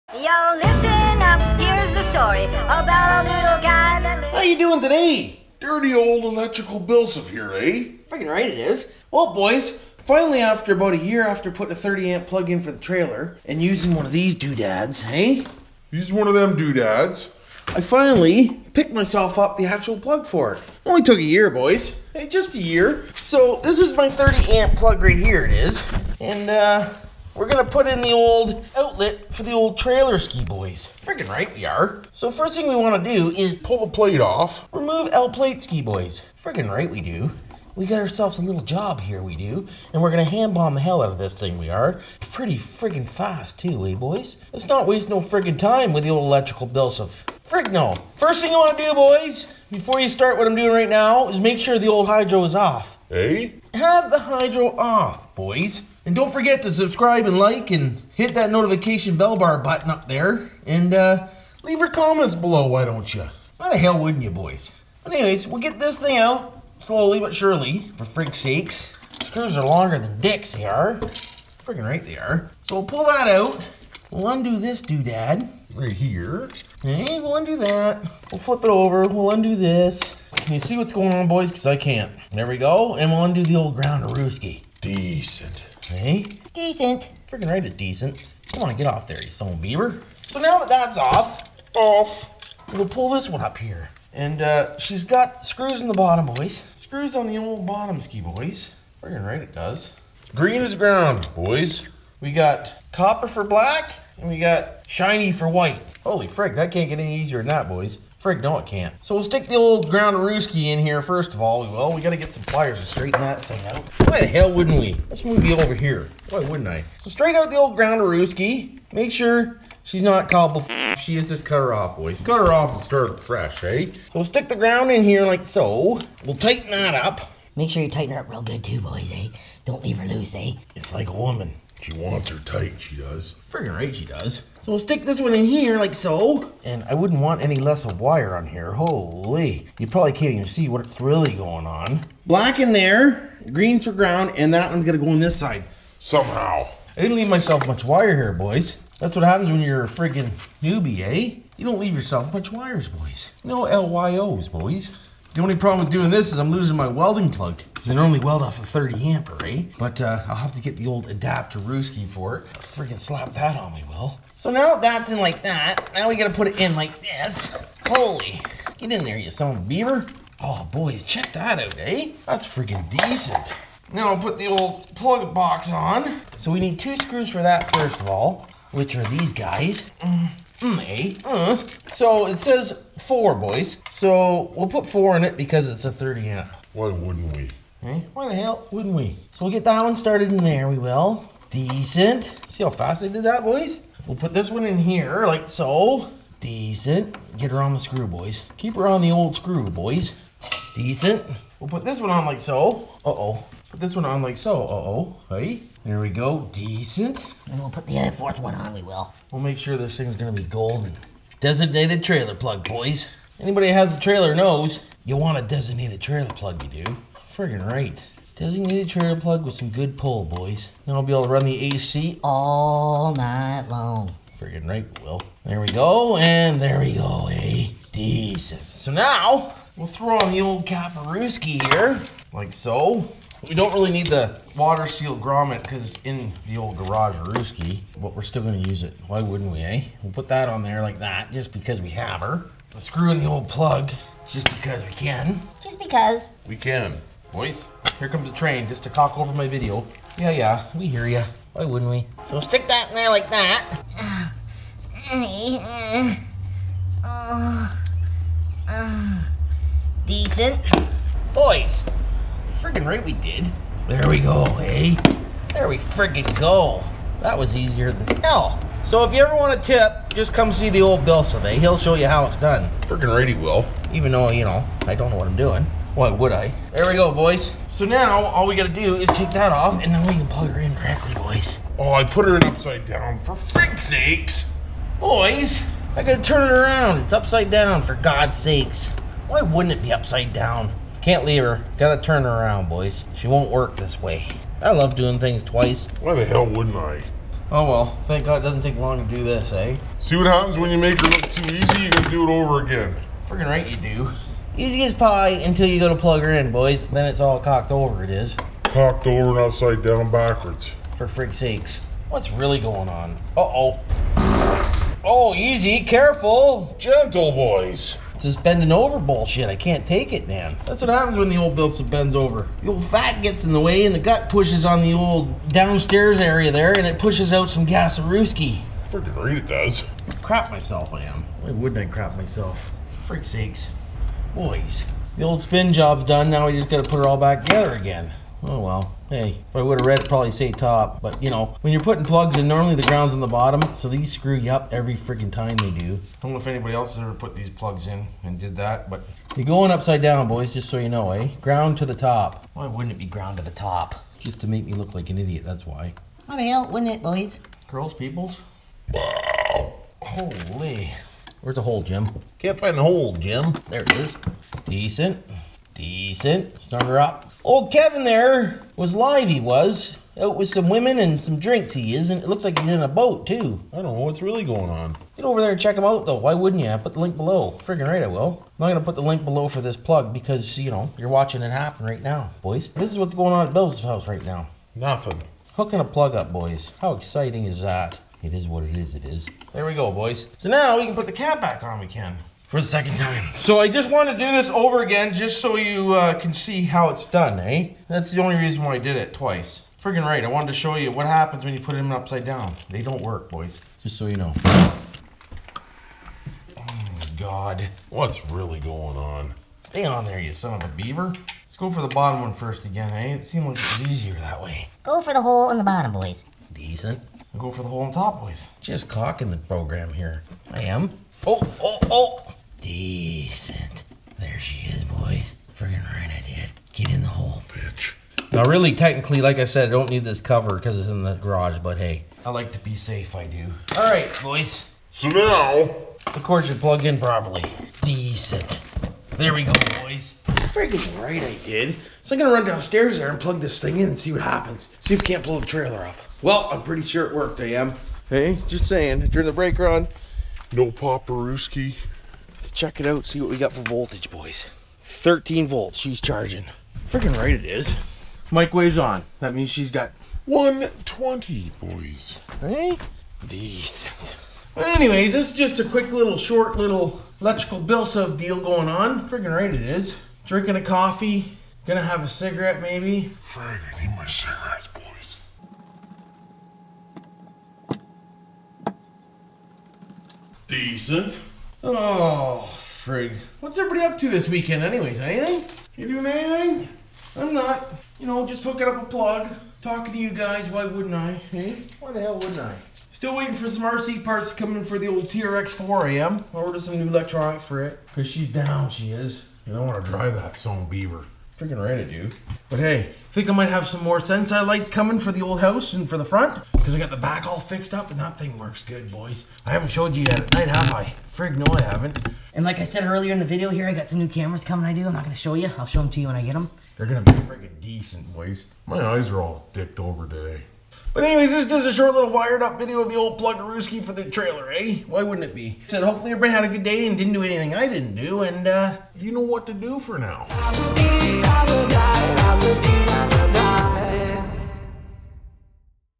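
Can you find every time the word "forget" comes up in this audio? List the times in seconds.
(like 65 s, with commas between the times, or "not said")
56 s.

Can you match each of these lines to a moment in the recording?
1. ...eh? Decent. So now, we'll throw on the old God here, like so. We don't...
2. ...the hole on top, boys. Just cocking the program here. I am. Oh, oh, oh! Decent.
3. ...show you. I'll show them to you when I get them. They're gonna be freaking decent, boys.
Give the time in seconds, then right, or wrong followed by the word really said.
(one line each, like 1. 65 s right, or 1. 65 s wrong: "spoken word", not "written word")
1. 227 s wrong: "Kaparuski", not "God"
2. 417 s right
3. 515 s right.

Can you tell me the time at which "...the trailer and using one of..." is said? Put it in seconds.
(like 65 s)
12 s.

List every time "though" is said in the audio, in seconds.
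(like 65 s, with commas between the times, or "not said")
274 s, 376 s.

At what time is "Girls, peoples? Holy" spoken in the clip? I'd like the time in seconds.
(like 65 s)
357 s.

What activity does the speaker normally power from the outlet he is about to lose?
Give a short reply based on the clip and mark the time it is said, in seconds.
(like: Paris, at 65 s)
Welding, at 158 s.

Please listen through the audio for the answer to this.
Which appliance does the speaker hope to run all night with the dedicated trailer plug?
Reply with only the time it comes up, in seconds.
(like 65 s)
221 s.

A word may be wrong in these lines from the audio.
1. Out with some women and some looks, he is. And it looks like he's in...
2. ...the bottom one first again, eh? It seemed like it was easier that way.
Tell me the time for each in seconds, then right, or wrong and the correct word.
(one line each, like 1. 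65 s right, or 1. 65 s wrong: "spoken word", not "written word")
1. 370 s wrong: "drinks", not "looks"
2. 411 s right.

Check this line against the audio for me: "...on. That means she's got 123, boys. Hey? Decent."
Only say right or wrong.
wrong.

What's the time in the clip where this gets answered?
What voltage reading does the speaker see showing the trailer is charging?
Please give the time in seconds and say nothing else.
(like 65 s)
454 s.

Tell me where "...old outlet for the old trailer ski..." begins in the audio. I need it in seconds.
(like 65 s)
28 s.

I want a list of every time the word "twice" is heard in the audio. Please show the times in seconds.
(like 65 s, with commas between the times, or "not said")
295 s, 399 s.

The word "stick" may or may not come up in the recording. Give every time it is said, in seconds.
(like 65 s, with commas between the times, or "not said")
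109 s, 124 s, 134 s, 252 s.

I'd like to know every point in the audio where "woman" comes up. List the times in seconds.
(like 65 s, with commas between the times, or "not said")
131 s.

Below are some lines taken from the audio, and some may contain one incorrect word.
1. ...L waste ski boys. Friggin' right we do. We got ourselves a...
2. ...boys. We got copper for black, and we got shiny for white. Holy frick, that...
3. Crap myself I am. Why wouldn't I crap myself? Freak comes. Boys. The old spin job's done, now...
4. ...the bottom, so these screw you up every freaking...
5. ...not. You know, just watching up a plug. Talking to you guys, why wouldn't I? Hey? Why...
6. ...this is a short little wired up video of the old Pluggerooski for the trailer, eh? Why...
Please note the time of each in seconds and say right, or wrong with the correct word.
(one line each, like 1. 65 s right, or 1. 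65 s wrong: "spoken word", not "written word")
1. 35 s wrong: "plate", not "waste"
2. 101 s right
3. 330 s wrong: "sakes", not "comes"
4. 343 s right
5. 487 s wrong: "hooking", not "watching"
6. 521 s right.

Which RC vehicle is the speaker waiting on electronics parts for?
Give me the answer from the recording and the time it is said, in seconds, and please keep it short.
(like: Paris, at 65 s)
TRX 4, at 495 s.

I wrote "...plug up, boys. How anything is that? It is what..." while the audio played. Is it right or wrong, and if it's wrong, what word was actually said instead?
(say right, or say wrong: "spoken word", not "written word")
wrong: "exciting", not "anything".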